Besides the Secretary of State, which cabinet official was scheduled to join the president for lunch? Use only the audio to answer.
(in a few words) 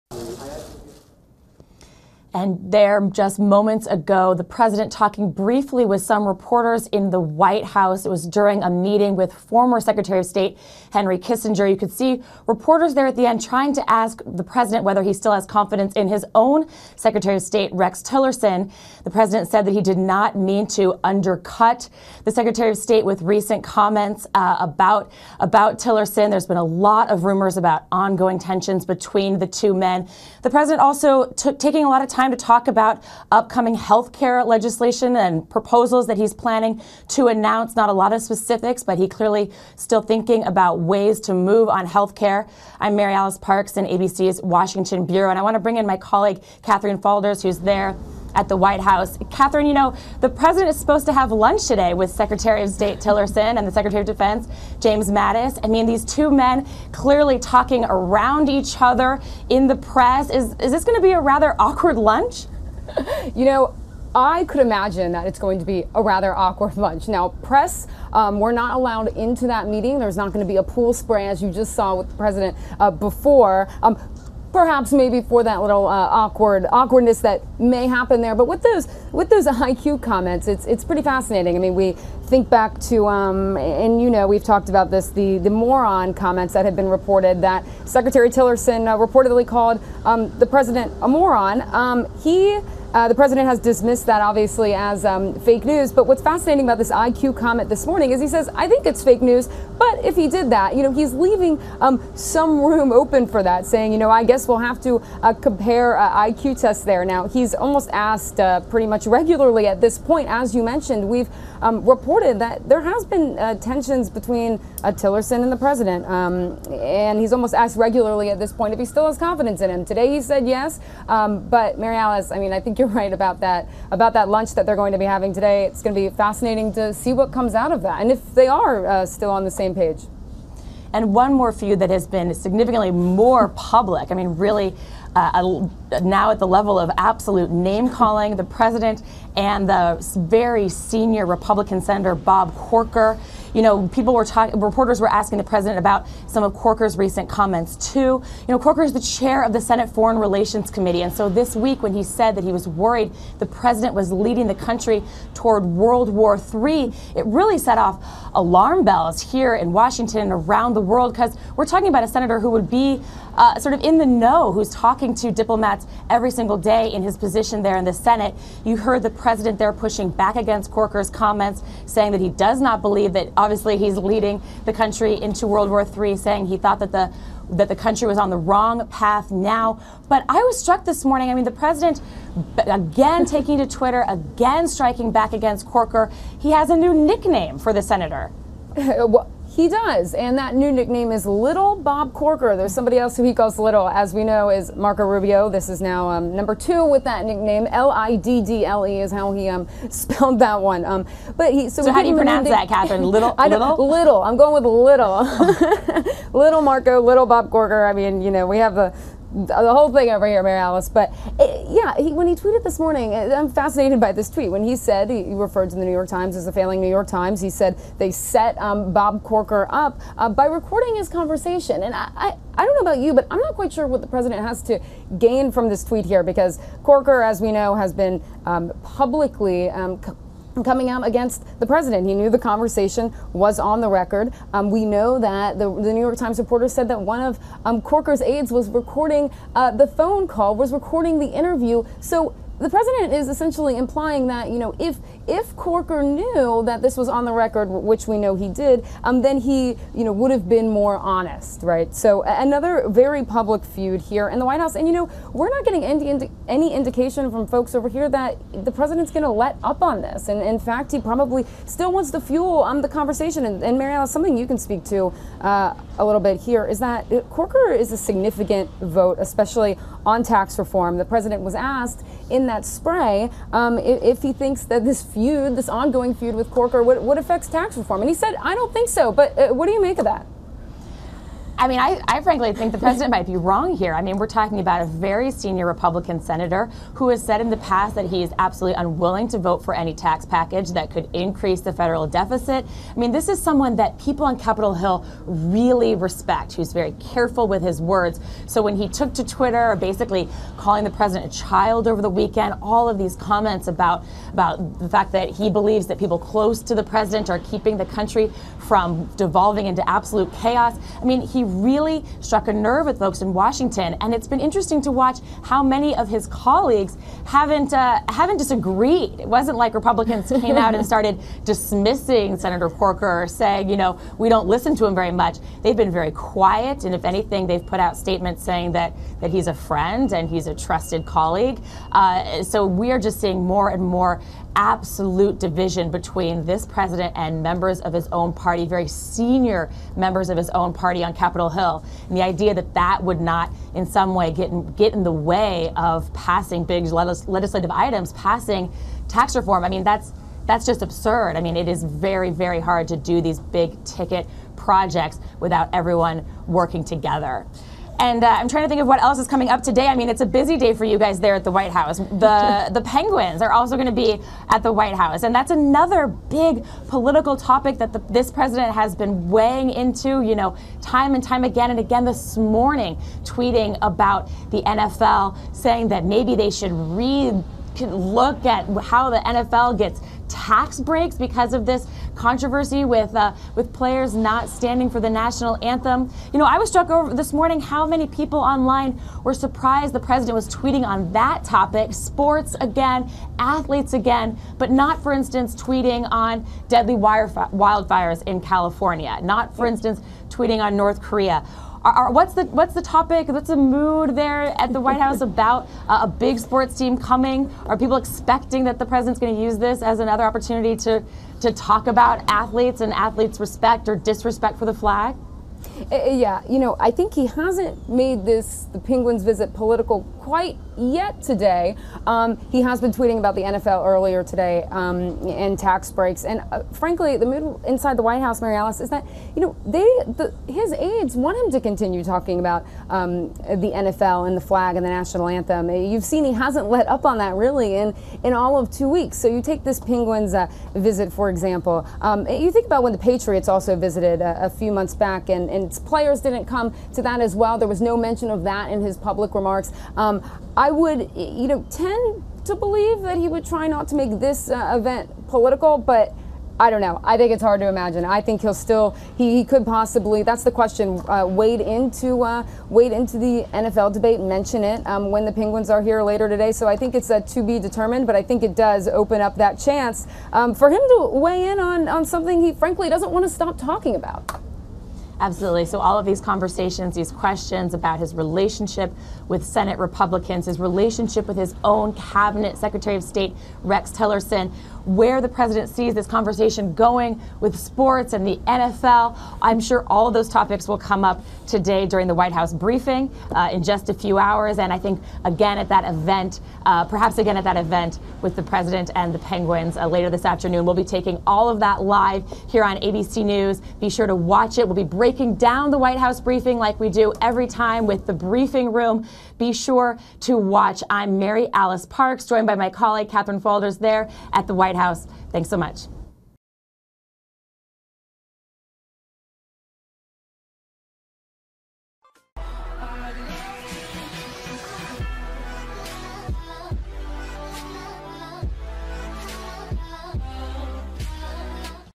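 James Mattis.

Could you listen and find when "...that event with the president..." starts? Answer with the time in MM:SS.
08:17.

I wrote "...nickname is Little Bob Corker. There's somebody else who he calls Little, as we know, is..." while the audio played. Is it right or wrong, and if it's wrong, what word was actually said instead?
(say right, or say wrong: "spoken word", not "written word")
right.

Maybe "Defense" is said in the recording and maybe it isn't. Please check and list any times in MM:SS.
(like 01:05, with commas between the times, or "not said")
00:54.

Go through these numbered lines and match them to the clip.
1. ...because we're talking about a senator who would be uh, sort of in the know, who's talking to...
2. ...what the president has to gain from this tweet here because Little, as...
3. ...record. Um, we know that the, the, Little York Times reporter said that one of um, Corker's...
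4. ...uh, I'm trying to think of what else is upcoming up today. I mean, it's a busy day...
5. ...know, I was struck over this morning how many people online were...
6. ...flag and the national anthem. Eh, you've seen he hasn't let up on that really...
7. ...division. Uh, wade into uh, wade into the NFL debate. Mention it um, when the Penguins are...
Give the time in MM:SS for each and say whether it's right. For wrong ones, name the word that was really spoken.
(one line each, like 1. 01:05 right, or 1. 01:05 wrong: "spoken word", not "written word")
1. 02:41 right
2. 03:43 wrong: "Corker", not "Little"
3. 03:53 wrong: "New", not "Little"
4. 05:58 wrong: "coming", not "upcoming"
5. 06:26 right
6. 07:14 right
7. 07:40 wrong: "question", not "division".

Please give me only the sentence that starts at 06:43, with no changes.
What's the mood there at the White House about uh, a big sports team coming?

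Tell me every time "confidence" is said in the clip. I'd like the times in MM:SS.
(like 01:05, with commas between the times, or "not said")
00:15, 01:59.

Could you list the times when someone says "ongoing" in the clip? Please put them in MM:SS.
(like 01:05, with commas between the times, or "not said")
00:27, 04:35.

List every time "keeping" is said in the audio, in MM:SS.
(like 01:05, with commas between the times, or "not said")
05:07.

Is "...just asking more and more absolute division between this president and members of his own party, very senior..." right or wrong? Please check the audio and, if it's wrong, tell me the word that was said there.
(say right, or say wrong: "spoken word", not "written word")
wrong: "seeing", not "asking".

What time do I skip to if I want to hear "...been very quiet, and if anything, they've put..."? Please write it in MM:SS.
05:25.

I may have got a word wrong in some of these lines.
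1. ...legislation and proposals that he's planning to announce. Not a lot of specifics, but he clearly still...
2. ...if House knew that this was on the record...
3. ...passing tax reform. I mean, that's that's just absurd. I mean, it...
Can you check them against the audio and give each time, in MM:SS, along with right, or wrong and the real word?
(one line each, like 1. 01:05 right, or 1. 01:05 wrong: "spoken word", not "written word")
1. 00:34 right
2. 04:05 wrong: "Corker", not "House"
3. 05:48 right.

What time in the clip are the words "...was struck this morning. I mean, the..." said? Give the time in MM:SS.
03:00.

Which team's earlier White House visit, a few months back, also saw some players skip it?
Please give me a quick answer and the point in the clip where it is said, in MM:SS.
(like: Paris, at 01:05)
the Patriots, at 07:22.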